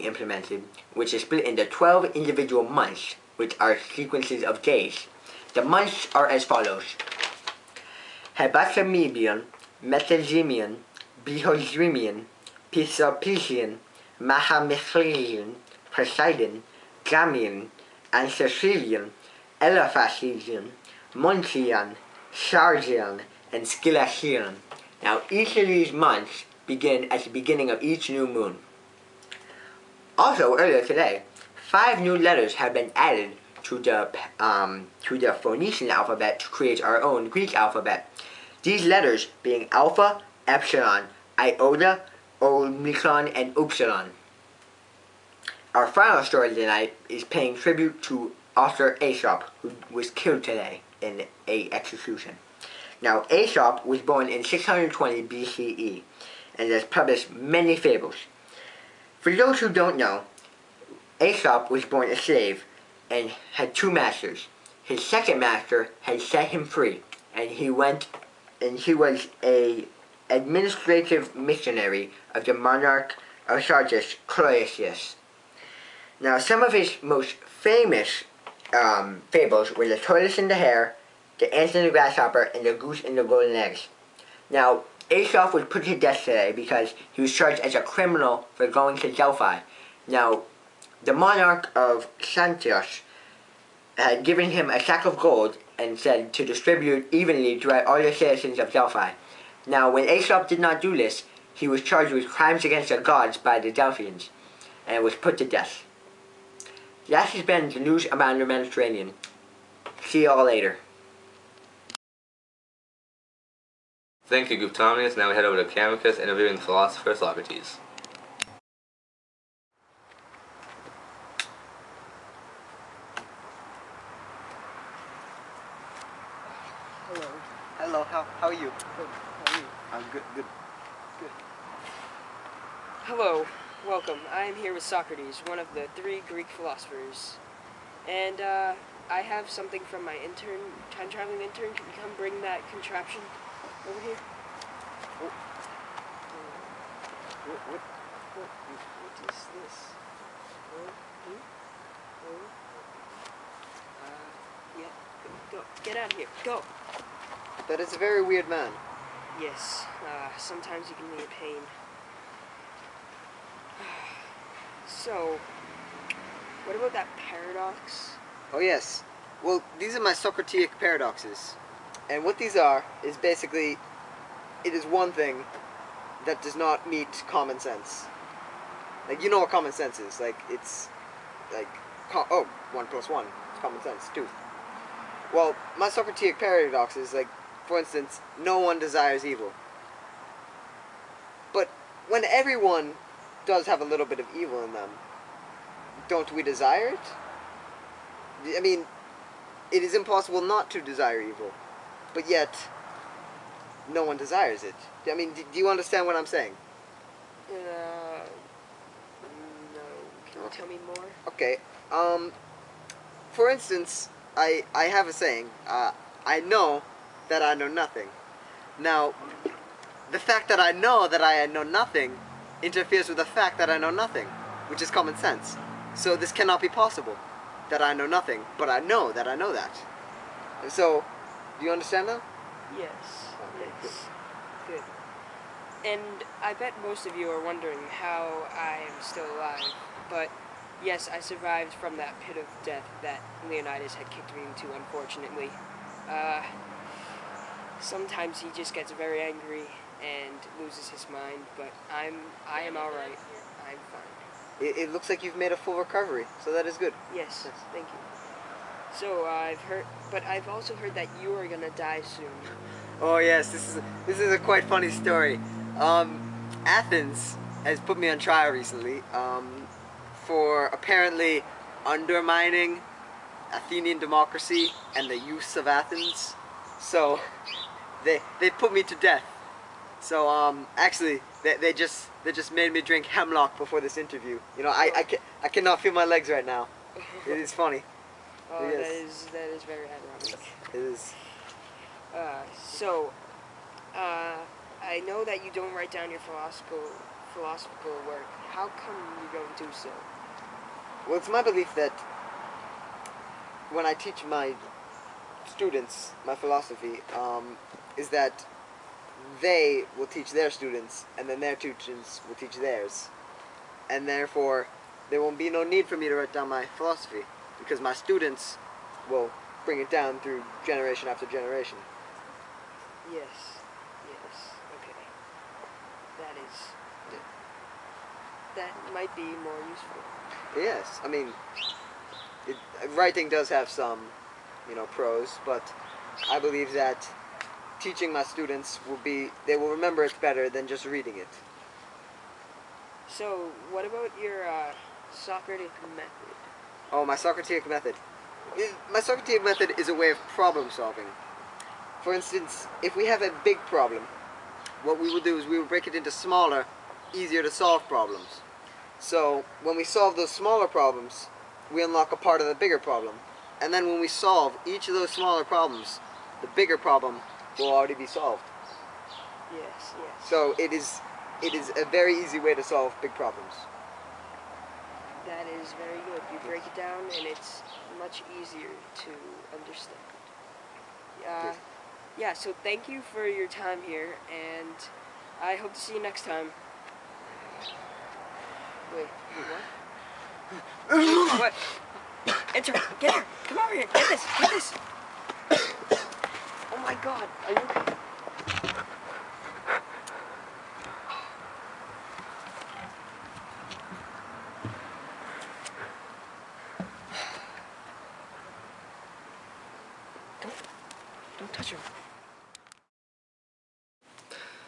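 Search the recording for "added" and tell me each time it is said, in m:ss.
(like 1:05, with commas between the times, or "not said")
0:32.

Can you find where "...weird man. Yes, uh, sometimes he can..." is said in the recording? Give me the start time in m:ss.
2:38.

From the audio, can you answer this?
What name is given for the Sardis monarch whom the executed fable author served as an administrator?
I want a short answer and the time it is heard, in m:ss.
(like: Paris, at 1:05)
Cloisius, at 1:14.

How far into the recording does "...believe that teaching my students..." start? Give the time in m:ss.
5:36.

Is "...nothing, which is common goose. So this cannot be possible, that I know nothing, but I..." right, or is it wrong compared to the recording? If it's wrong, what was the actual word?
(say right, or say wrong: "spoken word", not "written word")
wrong: "sense", not "goose".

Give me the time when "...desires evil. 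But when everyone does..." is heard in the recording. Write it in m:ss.
3:08.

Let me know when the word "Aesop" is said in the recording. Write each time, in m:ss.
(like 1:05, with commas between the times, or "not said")
0:49, 0:53, 1:01, 1:25, 1:40.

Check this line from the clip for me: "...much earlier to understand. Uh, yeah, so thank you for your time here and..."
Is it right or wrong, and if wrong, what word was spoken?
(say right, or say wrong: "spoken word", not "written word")
wrong: "easier", not "earlier".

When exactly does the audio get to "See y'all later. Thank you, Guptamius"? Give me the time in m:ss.
1:50.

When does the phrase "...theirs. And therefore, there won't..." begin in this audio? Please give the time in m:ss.
5:12.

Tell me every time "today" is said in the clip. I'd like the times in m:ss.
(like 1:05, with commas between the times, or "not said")
0:30, 0:50, 1:26.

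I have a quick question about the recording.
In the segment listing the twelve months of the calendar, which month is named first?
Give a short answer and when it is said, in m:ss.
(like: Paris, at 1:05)
Hepathamebian, at 0:08.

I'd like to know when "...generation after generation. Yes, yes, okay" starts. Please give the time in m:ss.
5:20.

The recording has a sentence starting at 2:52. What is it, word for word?
And what these are is basically, it is one thing that does not meet common sense.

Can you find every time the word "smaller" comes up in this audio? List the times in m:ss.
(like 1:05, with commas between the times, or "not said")
5:56, 6:00, 6:05.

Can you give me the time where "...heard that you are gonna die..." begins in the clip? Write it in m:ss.
4:20.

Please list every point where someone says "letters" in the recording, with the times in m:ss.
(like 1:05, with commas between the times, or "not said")
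0:32, 0:38.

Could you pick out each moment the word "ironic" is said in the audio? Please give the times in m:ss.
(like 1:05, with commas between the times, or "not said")
4:49.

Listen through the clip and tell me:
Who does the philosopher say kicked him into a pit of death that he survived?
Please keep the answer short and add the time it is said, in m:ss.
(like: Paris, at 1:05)
Leonidas, at 4:03.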